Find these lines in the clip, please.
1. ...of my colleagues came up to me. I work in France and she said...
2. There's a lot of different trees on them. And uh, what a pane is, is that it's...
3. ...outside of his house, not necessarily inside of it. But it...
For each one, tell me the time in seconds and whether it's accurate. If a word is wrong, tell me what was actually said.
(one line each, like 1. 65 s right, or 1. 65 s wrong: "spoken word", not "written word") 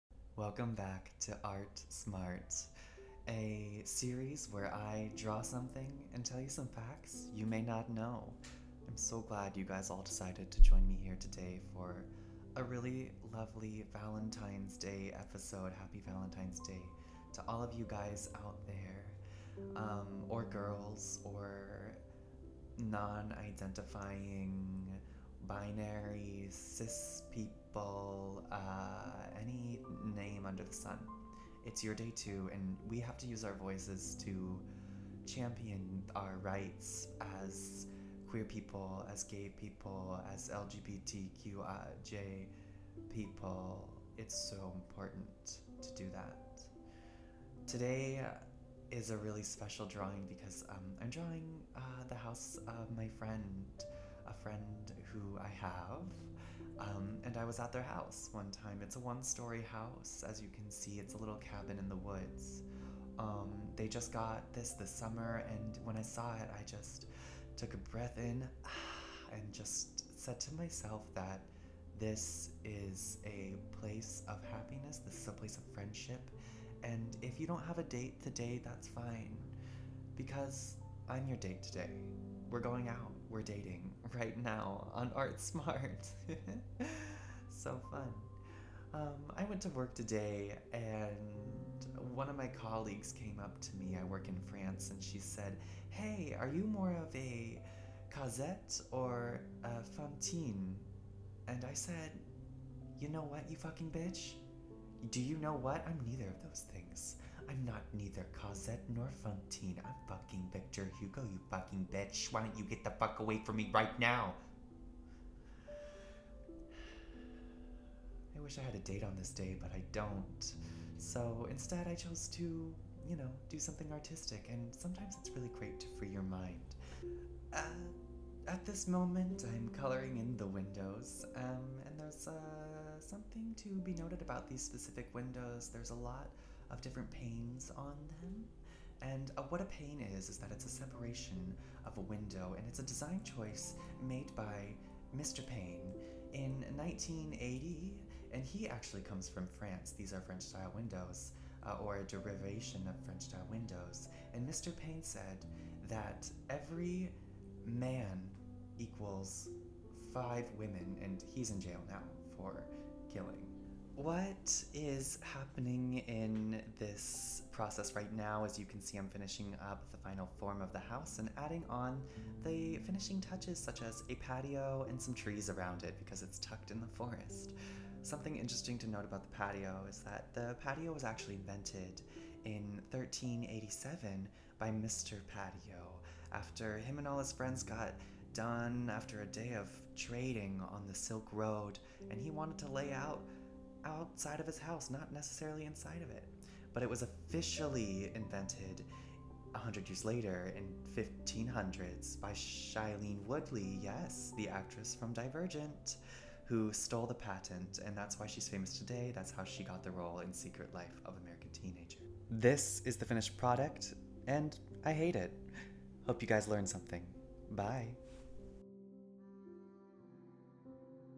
1. 92 s right
2. 135 s wrong: "panes", not "trees"
3. 193 s right.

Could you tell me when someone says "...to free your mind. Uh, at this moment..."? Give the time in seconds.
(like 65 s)
125 s.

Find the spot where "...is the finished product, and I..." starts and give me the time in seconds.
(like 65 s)
212 s.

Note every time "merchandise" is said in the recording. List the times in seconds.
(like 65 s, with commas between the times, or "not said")
not said.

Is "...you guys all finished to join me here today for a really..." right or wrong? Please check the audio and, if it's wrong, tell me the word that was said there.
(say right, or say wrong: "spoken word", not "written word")
wrong: "decided", not "finished".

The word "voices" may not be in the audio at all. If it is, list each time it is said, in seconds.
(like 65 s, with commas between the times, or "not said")
33 s.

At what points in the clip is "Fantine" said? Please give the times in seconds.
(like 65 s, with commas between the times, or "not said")
99 s, 109 s.